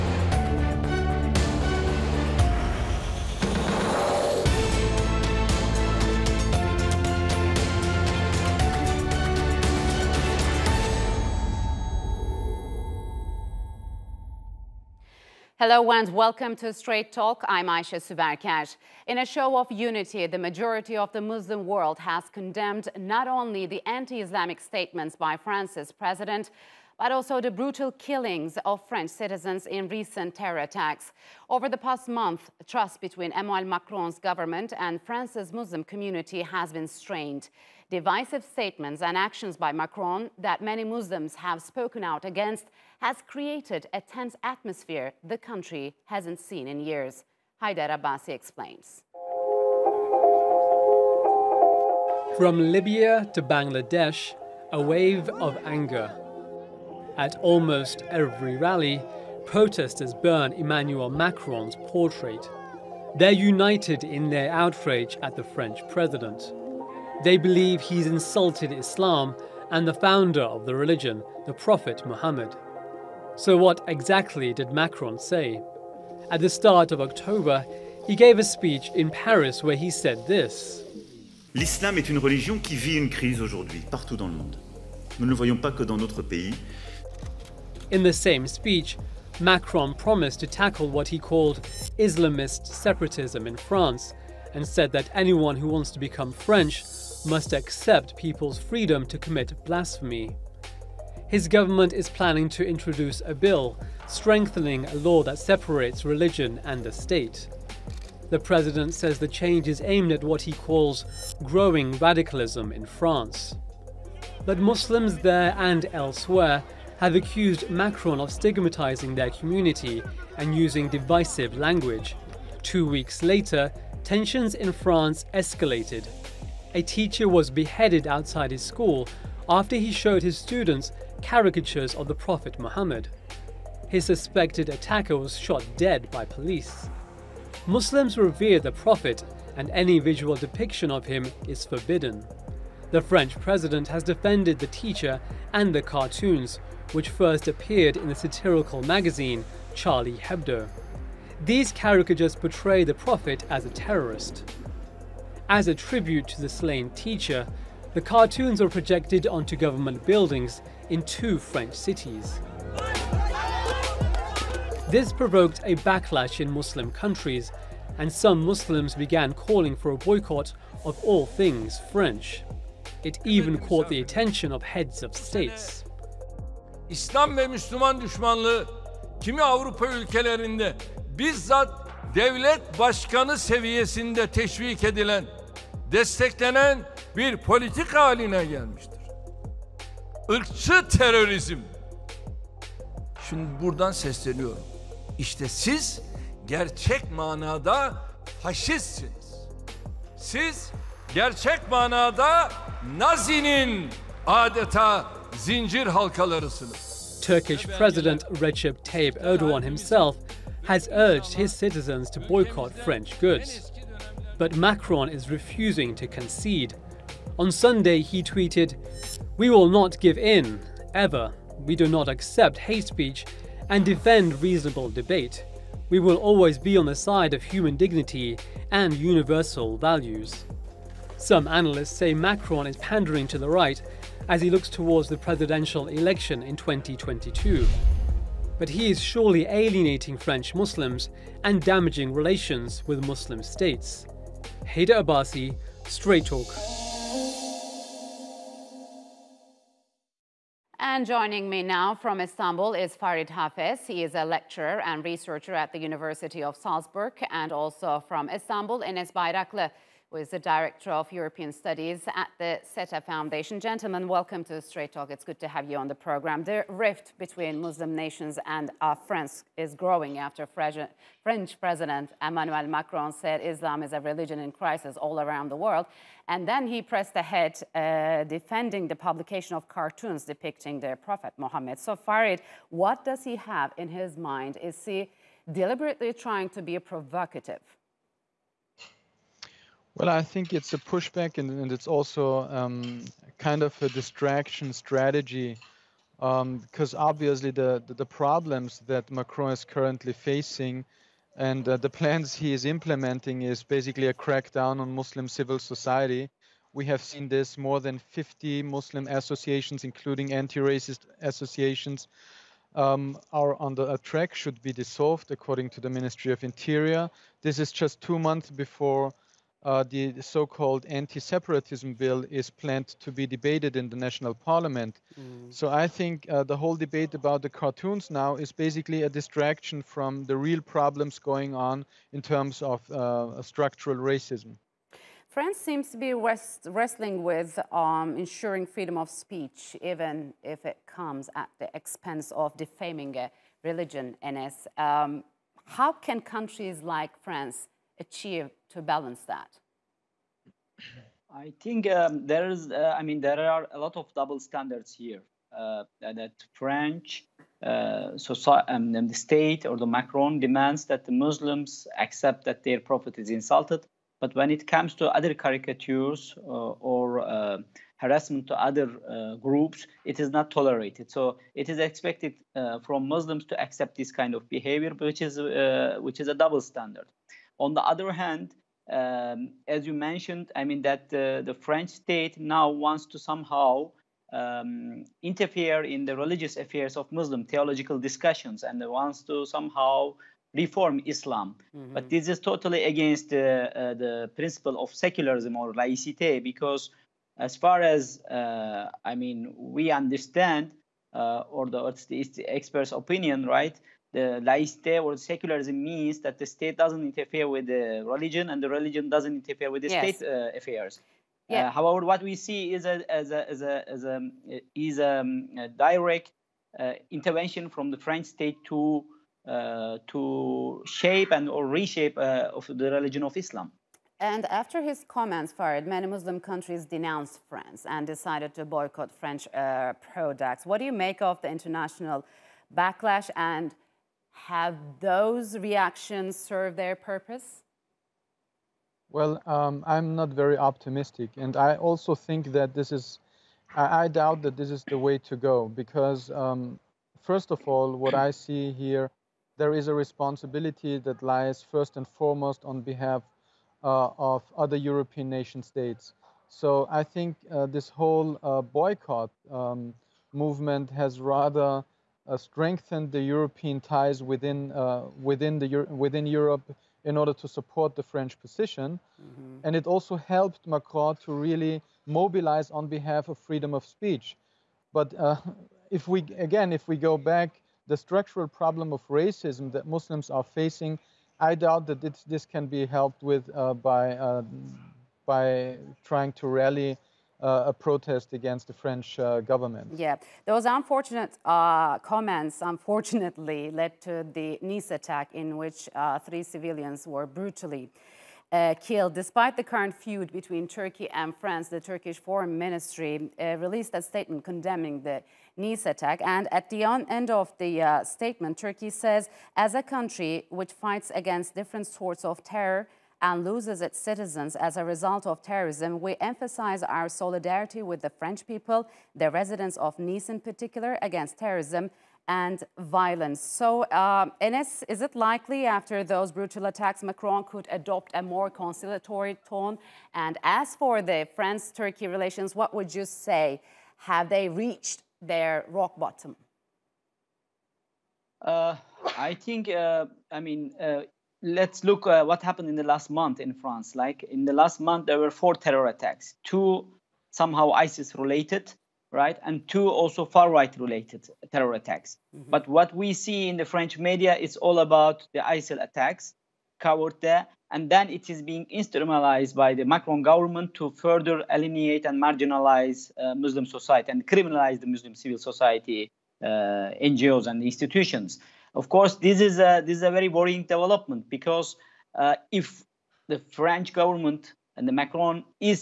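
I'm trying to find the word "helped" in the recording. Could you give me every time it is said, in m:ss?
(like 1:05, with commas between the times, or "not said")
7:50, 8:02.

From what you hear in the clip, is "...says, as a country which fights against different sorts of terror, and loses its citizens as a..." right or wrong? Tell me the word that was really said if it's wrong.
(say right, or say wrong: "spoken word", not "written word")
right.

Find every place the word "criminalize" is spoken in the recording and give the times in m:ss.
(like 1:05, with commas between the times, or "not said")
9:24.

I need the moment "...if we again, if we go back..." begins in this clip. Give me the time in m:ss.
7:55.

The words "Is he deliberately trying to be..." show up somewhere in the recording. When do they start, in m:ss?
4:44.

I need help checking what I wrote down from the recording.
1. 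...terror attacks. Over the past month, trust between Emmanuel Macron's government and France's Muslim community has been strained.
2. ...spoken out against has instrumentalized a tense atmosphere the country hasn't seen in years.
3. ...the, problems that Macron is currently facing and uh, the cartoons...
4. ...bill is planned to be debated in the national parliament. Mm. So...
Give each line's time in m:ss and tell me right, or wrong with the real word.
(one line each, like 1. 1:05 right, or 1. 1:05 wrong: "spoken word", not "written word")
1. 0:30 right
2. 0:41 wrong: "created", not "instrumentalized"
3. 4:57 wrong: "plans", not "cartoons"
4. 5:21 right.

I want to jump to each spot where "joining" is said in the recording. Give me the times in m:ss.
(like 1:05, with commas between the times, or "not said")
4:11.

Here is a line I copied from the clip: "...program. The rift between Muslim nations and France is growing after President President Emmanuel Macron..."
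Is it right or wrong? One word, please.
wrong.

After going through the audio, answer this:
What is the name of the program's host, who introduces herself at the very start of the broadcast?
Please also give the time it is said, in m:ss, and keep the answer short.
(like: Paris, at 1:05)
Aisha Subarkash, at 0:17.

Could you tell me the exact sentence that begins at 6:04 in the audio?
But when it comes to other caricatures uh, or uh, harassment to other uh, groups, it is not tolerated.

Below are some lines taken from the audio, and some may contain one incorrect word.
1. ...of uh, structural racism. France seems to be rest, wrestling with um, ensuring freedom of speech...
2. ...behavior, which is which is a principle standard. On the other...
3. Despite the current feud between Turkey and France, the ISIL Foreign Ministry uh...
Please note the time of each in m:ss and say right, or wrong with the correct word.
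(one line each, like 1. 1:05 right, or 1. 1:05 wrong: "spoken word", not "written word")
1. 5:32 right
2. 6:14 wrong: "double", not "principle"
3. 8:19 wrong: "Turkish", not "ISIL".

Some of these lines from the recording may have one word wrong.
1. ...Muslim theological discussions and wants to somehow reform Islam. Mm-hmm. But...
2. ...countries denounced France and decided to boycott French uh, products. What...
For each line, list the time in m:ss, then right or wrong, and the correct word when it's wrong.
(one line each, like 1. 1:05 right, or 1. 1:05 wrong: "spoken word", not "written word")
1. 6:27 right
2. 7:06 right.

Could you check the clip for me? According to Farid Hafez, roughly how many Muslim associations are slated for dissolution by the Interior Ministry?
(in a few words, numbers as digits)
more than 50.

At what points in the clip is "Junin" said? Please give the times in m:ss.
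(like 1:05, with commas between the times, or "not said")
not said.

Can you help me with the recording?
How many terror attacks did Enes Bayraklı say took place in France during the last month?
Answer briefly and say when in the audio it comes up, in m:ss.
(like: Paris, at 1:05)
4, at 9:05.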